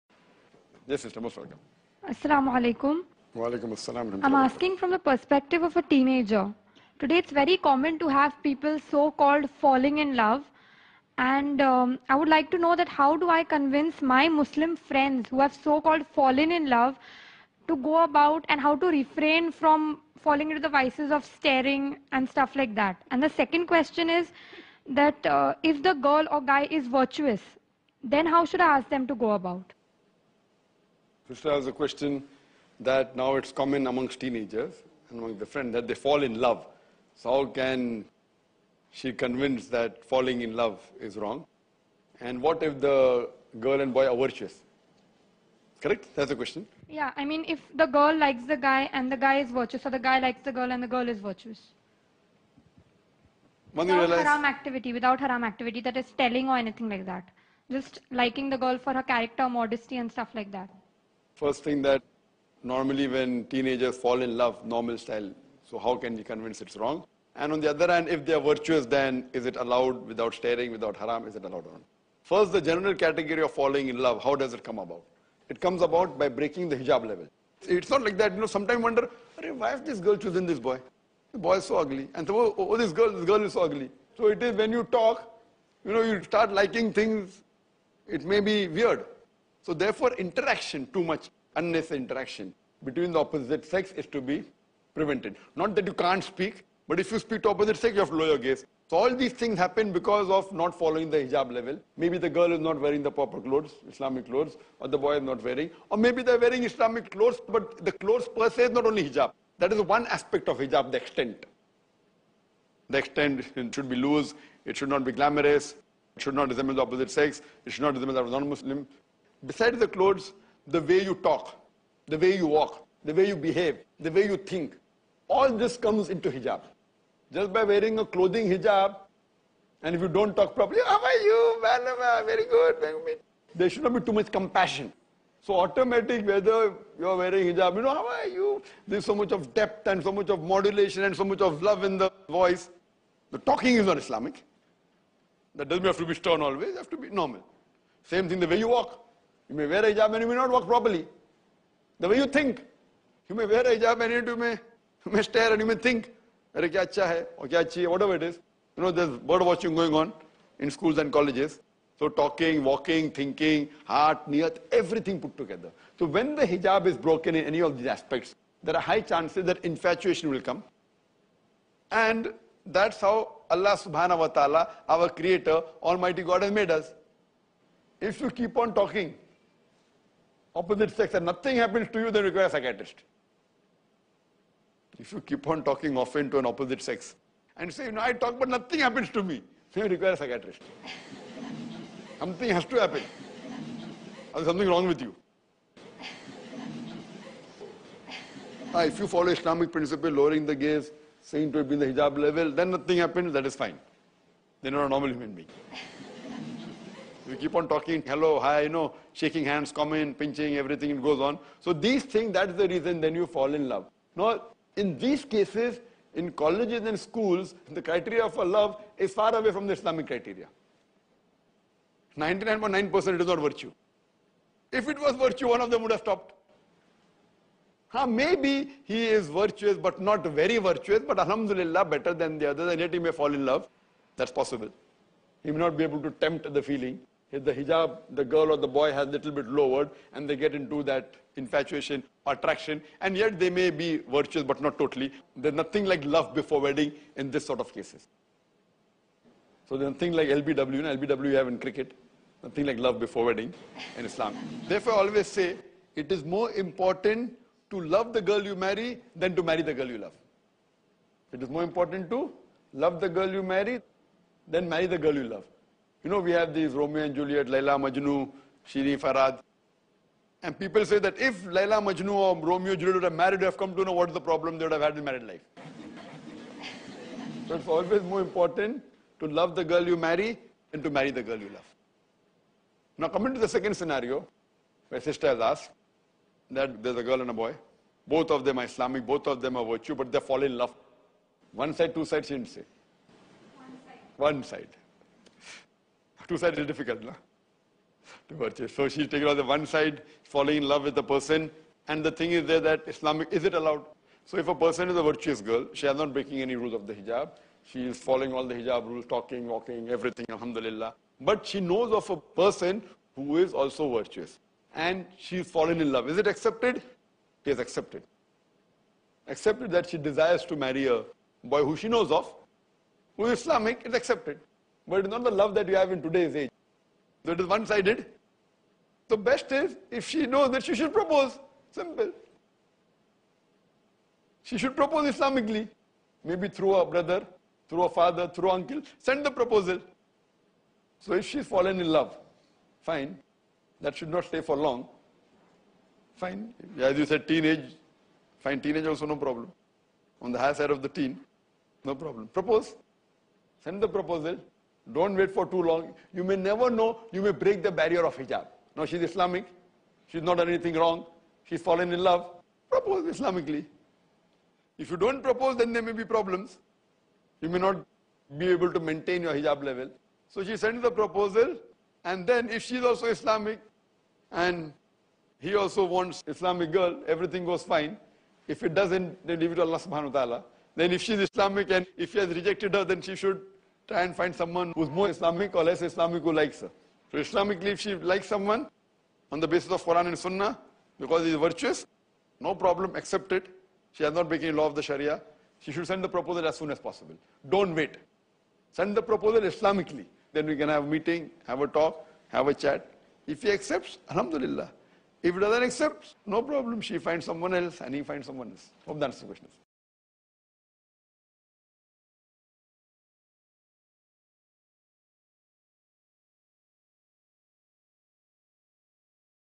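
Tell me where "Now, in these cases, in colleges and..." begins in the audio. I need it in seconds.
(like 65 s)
214 s.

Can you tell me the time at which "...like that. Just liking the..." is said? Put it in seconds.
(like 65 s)
56 s.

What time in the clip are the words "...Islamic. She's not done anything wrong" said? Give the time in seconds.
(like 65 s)
359 s.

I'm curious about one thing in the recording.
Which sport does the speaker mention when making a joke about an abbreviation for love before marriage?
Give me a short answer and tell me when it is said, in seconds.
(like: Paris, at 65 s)
cricket, at 251 s.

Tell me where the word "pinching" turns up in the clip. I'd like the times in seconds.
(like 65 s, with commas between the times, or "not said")
210 s.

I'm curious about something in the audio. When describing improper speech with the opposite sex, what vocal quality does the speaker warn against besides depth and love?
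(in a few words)
modulation.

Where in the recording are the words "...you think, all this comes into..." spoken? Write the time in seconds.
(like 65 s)
124 s.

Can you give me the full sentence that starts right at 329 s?
The best is if she knows that she should propose.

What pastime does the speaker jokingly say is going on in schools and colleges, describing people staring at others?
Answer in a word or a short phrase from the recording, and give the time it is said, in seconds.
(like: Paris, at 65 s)
bird watching, at 159 s.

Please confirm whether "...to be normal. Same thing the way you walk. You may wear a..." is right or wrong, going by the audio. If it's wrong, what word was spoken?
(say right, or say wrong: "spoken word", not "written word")
right.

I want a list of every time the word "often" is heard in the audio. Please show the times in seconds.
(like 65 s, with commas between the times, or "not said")
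185 s.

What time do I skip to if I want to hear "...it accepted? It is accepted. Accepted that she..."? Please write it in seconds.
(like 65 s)
316 s.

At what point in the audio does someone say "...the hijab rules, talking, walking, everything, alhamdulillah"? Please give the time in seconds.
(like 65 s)
308 s.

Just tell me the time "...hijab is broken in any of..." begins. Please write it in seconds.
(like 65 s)
166 s.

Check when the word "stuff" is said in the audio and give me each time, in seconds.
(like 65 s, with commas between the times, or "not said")
22 s, 60 s.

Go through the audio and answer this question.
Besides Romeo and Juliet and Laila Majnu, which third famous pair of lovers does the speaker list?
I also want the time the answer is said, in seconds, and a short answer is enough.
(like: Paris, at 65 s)
Shirin Farhad, at 268 s.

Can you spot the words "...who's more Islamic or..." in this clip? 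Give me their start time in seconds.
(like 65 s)
384 s.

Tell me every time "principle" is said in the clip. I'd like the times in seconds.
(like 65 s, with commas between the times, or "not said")
199 s.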